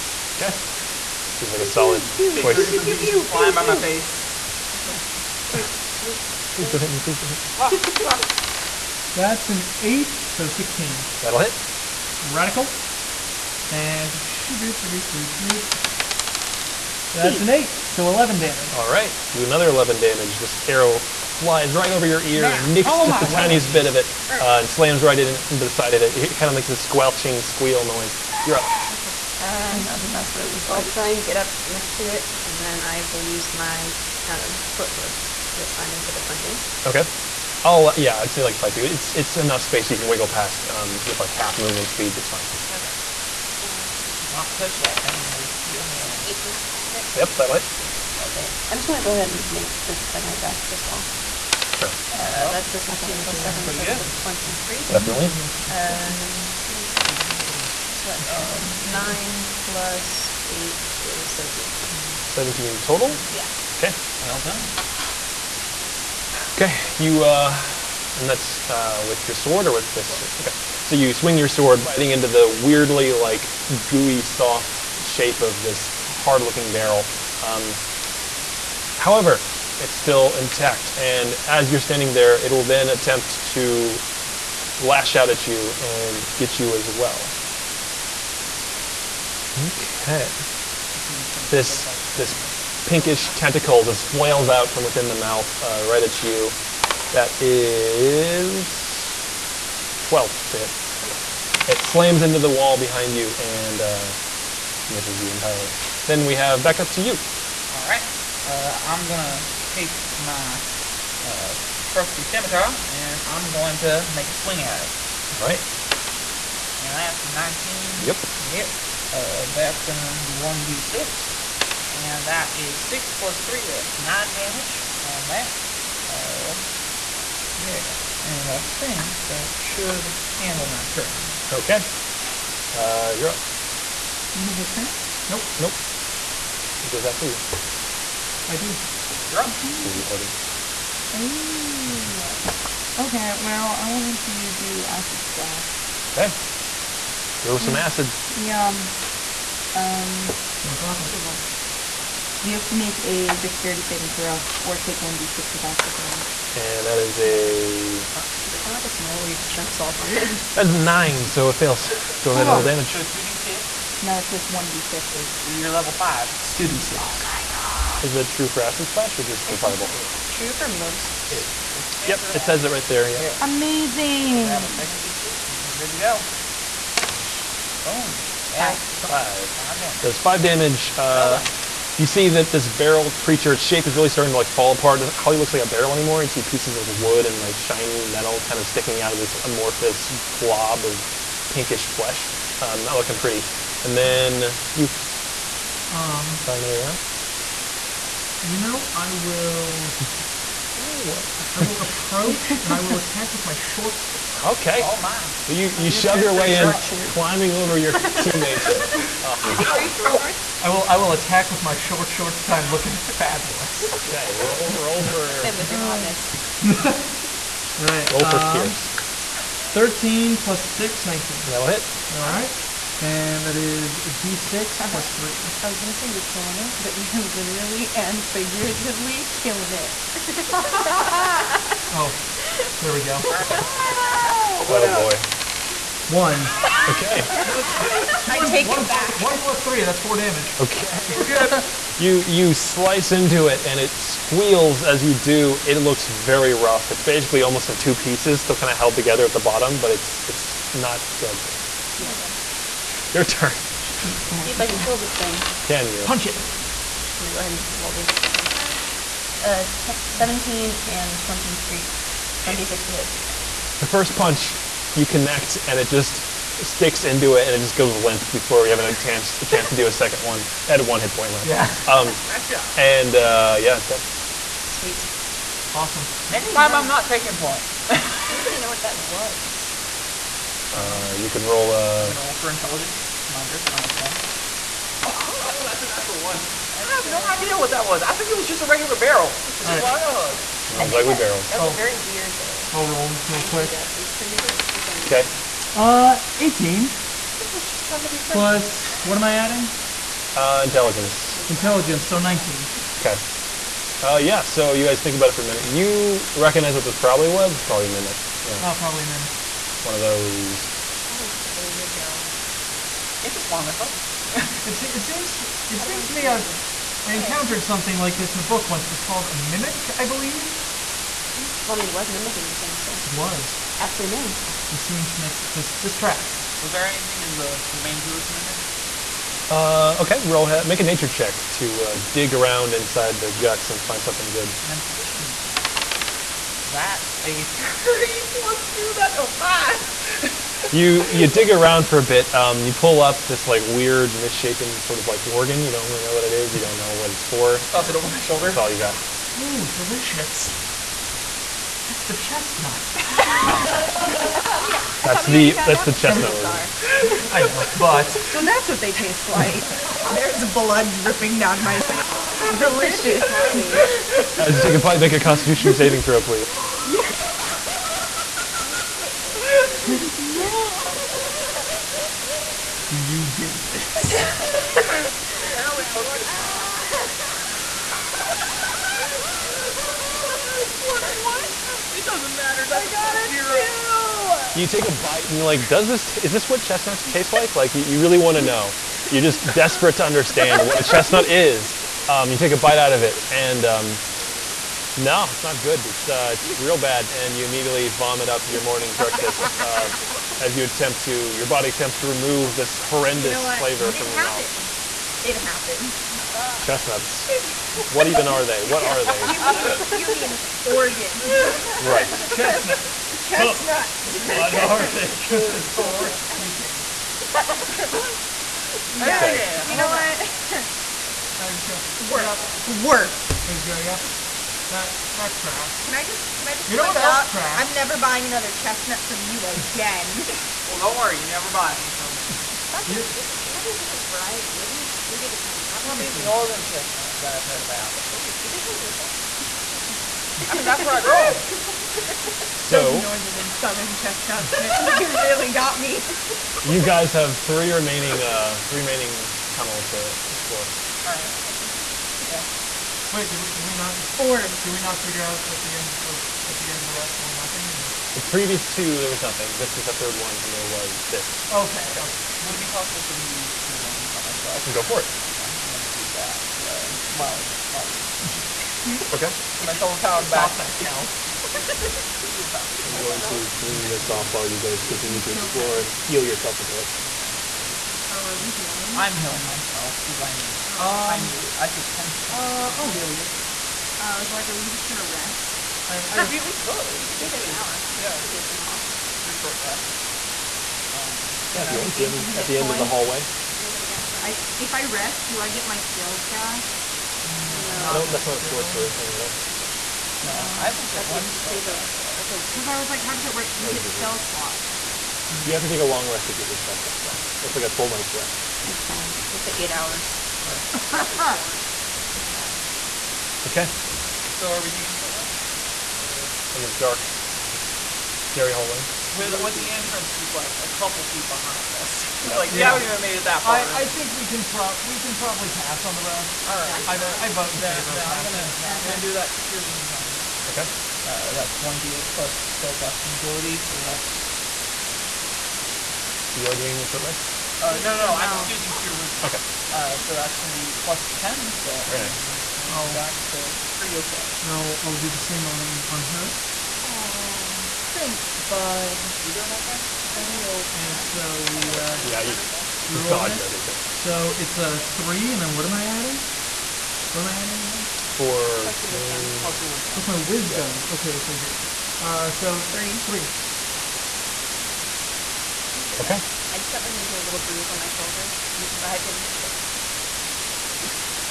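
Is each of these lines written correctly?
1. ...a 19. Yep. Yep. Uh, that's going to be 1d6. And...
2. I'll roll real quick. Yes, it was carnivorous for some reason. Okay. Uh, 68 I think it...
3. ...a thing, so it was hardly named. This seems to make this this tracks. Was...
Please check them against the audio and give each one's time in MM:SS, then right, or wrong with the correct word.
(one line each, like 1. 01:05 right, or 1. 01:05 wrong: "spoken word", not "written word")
1. 01:57 right
2. 04:52 wrong: "18", not "68"
3. 05:22 wrong: "aptly", not "hardly".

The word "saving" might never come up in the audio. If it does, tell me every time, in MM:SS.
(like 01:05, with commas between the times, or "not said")
02:33, 06:05.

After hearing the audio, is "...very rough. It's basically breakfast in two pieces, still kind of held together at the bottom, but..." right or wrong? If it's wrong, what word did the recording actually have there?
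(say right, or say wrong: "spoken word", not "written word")
wrong: "almost", not "breakfast".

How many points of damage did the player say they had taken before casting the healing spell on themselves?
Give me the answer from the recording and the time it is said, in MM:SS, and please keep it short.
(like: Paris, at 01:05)
10, at 08:01.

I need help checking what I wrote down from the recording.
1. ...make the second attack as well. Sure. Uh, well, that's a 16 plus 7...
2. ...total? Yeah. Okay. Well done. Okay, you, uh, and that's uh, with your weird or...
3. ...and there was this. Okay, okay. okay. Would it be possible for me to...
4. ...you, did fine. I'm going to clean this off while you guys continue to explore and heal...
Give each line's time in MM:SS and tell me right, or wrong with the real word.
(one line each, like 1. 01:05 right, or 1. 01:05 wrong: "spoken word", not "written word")
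1. 00:49 right
2. 01:02 wrong: "sword", not "weird"
3. 07:40 right
4. 07:52 right.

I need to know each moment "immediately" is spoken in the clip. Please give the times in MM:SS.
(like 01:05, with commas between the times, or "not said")
06:37.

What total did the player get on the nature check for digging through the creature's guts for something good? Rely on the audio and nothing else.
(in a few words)
5.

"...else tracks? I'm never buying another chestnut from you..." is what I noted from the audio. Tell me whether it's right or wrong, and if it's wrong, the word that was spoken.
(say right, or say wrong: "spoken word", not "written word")
right.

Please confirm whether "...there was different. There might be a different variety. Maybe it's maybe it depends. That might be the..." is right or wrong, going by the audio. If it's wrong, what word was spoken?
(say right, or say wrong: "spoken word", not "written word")
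right.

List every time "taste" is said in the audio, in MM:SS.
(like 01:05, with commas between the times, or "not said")
05:58, 06:27.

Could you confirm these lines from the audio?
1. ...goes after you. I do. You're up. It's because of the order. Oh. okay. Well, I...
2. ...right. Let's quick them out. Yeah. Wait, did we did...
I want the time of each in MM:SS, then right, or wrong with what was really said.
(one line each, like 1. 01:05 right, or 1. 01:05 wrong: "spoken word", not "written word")
1. 02:16 right
2. 07:31 wrong: "check", not "quick".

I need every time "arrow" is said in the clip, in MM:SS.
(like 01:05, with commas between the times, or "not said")
00:20, 03:16.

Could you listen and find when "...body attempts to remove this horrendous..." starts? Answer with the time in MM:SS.
06:41.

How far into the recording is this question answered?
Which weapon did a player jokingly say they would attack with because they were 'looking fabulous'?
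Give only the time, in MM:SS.
03:31.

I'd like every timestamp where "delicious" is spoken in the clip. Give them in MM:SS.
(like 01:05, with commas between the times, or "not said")
05:49, 06:02.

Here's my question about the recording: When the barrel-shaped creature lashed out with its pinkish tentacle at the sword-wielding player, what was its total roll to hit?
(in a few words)
12.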